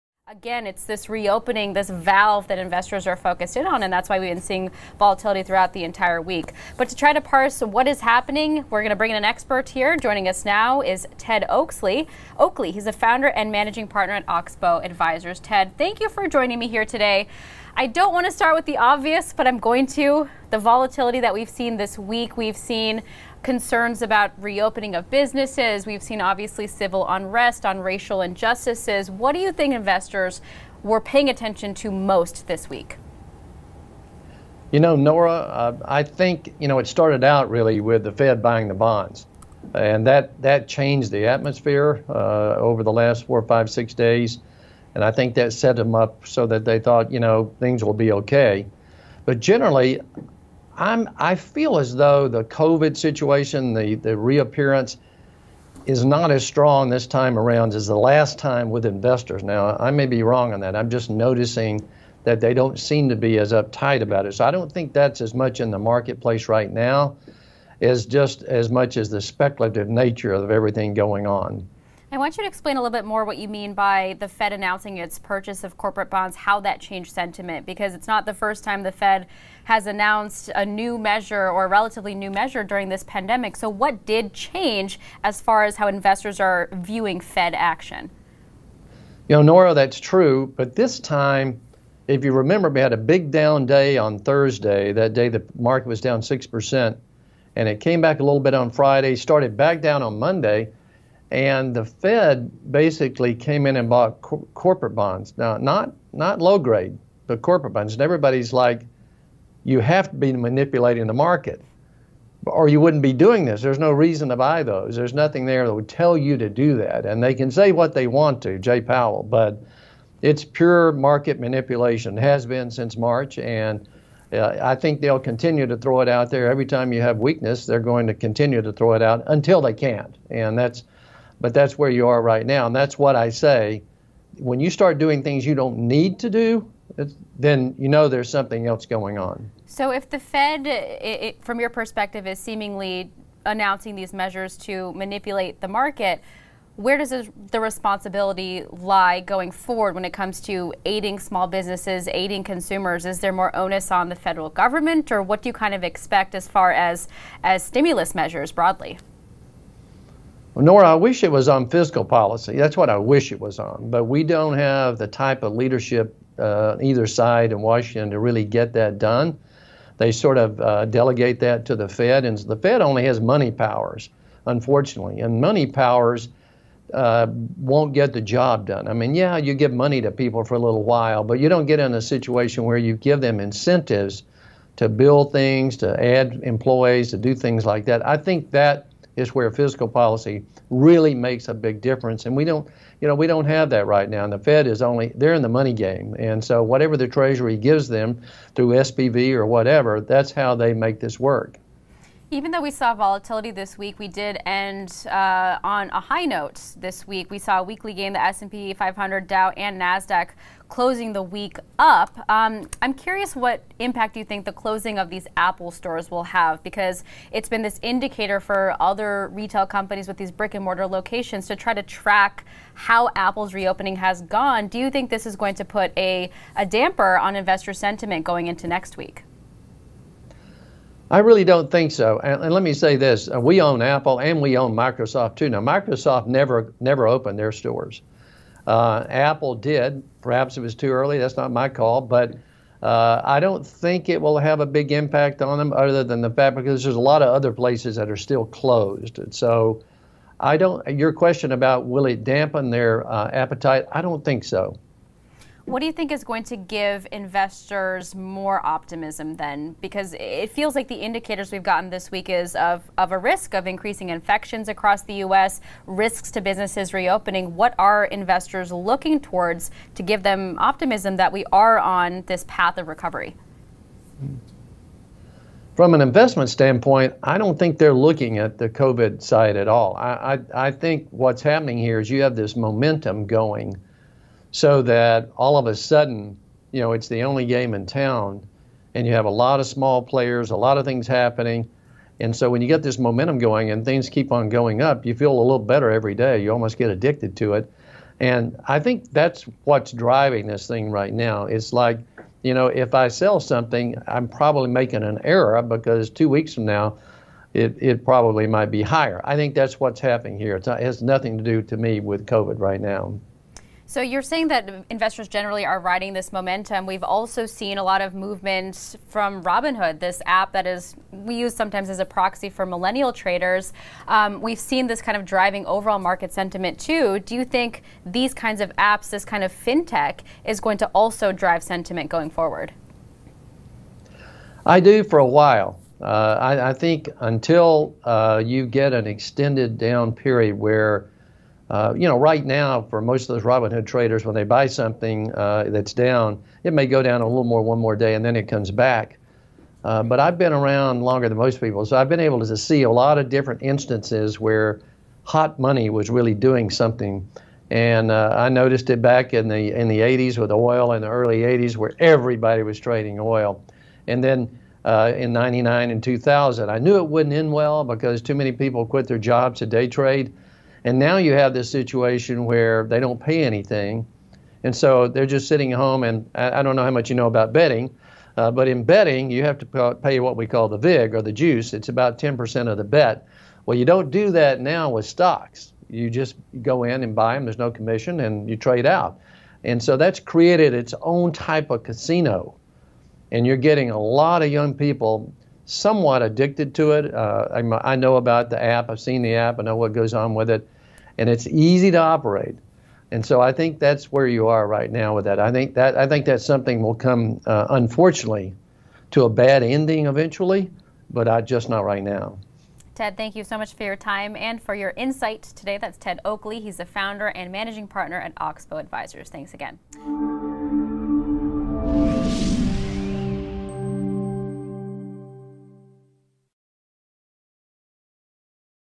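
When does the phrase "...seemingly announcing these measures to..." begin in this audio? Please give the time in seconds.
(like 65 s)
142 s.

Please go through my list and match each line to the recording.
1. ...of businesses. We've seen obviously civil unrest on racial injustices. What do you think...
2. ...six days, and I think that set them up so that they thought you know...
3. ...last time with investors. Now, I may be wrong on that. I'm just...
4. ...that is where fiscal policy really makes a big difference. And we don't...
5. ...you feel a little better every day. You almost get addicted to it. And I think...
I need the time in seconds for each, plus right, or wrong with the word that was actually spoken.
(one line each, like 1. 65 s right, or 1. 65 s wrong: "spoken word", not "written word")
1. 24 s right
2. 43 s right
3. 57 s right
4. 188 s right
5. 295 s right.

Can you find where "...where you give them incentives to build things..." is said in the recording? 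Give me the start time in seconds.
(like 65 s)
182 s.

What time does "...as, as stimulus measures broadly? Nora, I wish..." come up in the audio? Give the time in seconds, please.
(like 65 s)
156 s.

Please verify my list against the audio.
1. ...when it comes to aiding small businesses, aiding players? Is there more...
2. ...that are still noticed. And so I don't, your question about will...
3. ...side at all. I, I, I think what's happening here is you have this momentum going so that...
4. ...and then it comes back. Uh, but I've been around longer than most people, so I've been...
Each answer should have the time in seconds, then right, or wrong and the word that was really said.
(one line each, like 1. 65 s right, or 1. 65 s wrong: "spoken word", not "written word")
1. 149 s wrong: "consumers", not "players"
2. 247 s wrong: "closed", not "noticed"
3. 279 s right
4. 348 s right.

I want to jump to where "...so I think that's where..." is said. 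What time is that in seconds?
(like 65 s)
403 s.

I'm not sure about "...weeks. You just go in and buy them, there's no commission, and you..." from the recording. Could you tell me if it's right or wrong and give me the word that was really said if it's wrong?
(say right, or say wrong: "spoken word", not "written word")
wrong: "stocks", not "weeks".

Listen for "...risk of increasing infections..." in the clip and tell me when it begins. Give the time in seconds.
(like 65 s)
263 s.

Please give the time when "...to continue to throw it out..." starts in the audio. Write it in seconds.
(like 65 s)
128 s.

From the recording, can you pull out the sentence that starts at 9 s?
Joining us now is Ted Oakley.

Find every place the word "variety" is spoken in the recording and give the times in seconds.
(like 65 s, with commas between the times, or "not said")
not said.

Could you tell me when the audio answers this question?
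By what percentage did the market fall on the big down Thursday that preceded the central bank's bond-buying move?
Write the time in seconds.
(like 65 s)
96 s.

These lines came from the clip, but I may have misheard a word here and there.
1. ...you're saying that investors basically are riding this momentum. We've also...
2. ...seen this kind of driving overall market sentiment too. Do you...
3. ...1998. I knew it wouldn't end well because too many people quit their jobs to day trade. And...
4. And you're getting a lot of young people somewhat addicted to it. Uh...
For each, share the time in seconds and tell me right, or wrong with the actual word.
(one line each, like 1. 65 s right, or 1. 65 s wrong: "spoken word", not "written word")
1. 313 s wrong: "generally", not "basically"
2. 324 s right
3. 366 s wrong: "2000", not "1998"
4. 393 s right.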